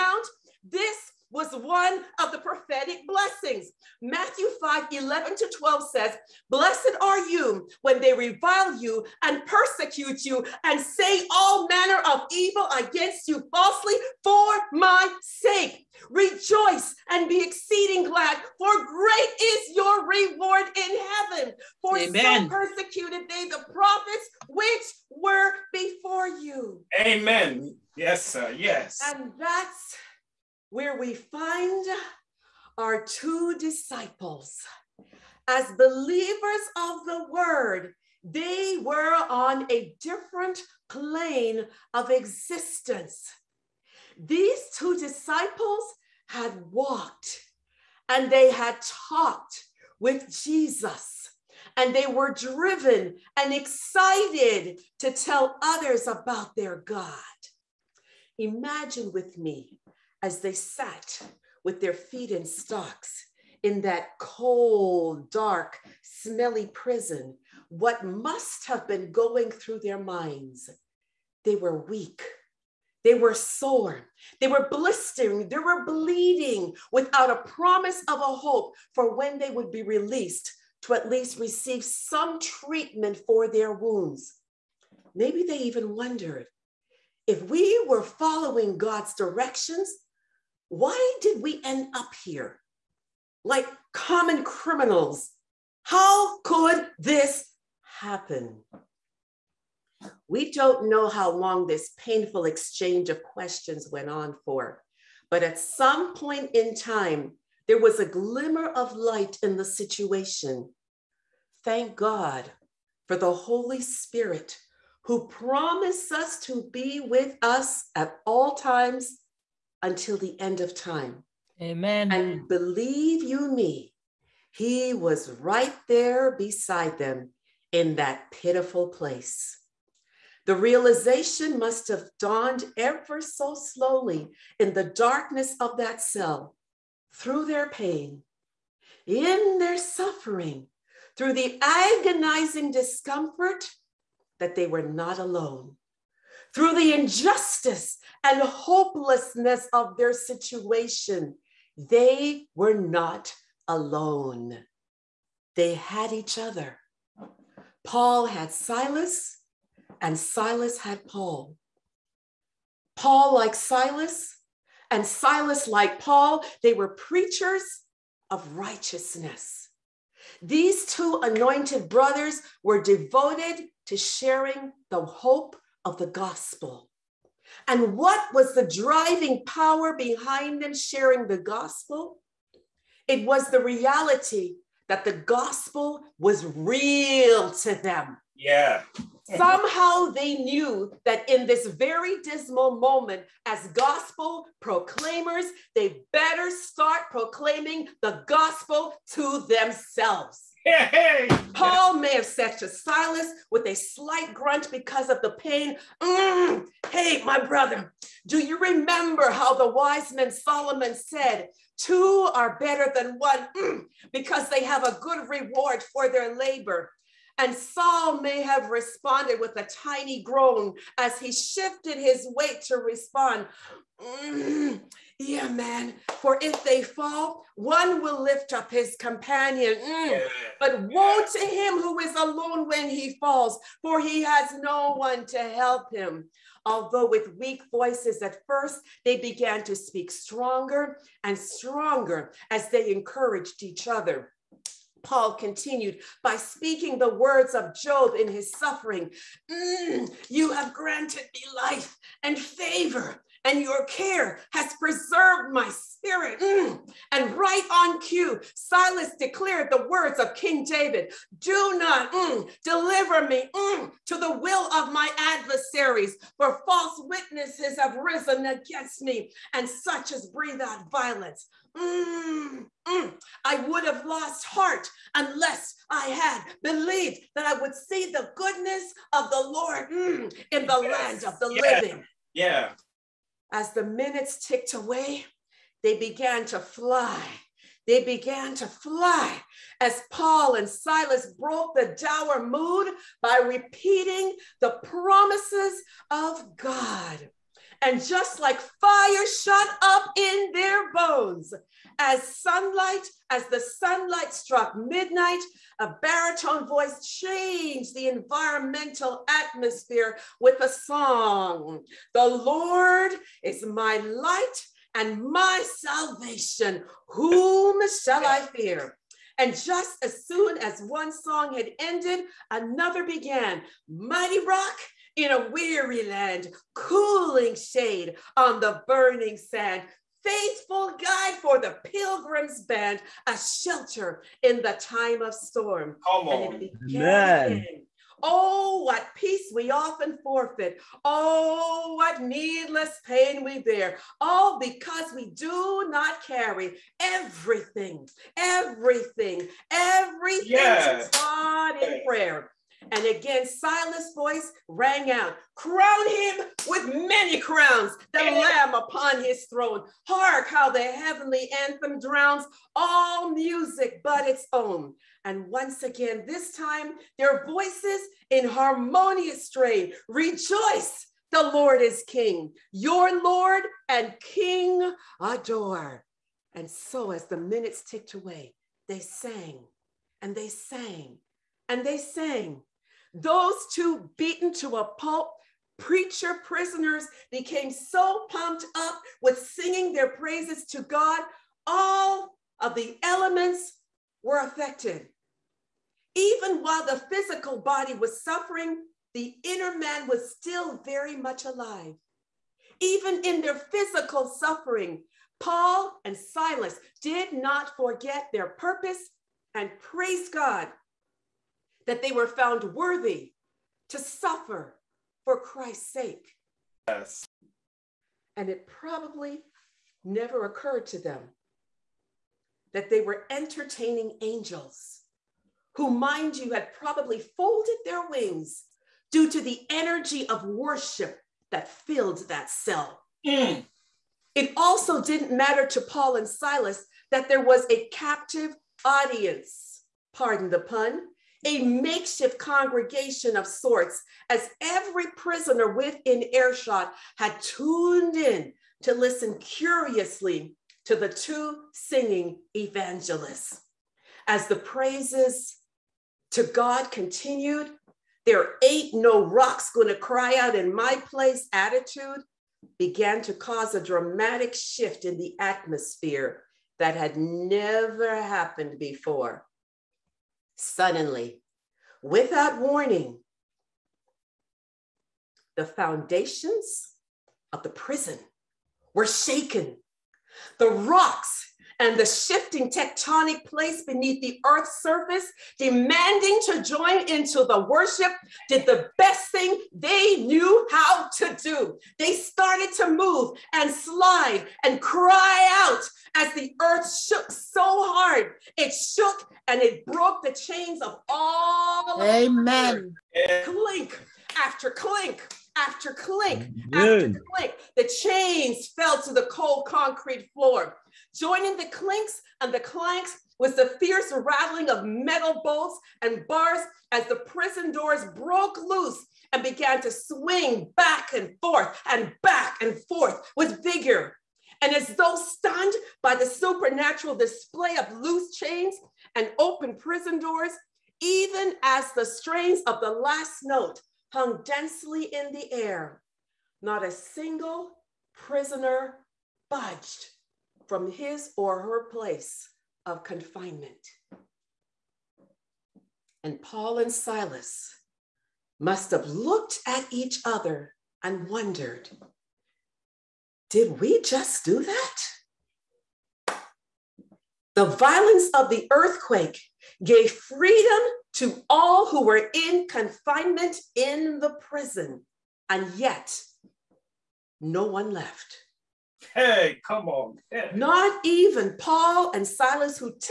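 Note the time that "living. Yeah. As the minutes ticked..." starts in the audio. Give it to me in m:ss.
4:41.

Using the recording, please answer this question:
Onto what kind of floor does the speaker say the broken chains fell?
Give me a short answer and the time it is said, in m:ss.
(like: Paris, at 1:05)
Cold concrete floor, at 8:29.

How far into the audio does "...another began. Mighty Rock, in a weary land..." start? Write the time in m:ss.
5:22.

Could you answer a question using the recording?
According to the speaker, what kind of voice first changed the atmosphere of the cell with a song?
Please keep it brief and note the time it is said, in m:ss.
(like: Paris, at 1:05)
Baritone, at 5:06.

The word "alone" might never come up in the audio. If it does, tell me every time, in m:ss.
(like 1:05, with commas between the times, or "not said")
2:25, 2:33, 3:52.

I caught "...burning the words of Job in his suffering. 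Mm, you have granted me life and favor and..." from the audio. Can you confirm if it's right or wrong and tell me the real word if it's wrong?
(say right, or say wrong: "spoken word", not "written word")
wrong: "speaking", not "burning".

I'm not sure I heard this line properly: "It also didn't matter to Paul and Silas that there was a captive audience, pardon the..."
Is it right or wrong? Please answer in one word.
right.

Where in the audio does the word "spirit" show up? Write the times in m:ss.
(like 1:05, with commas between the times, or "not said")
1:53, 4:15.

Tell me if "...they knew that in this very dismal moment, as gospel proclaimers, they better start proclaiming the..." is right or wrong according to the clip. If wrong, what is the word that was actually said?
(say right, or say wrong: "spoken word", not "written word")
right.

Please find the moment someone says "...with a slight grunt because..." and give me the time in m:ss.
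3:23.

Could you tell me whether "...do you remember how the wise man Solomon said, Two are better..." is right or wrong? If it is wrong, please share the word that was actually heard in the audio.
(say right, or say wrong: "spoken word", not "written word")
right.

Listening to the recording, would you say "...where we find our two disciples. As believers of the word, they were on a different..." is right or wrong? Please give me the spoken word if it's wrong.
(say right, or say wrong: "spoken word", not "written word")
right.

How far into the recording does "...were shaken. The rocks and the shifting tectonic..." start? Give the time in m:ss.
7:58.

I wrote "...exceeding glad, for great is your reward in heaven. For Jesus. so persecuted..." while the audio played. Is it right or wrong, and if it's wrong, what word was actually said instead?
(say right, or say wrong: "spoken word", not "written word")
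wrong: "Amen", not "Jesus".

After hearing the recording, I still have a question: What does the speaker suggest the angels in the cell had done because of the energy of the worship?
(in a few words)
Folded their wings.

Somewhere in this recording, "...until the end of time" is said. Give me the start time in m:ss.
1:59.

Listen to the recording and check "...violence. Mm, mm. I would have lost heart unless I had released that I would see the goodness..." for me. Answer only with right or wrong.
wrong.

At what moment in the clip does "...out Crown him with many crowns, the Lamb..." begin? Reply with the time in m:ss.
5:55.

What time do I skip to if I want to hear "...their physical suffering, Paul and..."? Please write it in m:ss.
6:43.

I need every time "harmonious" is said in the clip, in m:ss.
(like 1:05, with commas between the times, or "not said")
6:08.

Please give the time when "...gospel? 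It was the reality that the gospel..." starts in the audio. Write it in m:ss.
3:01.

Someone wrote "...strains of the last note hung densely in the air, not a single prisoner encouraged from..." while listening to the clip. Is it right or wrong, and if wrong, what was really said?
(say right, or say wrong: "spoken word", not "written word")
wrong: "budged", not "encouraged".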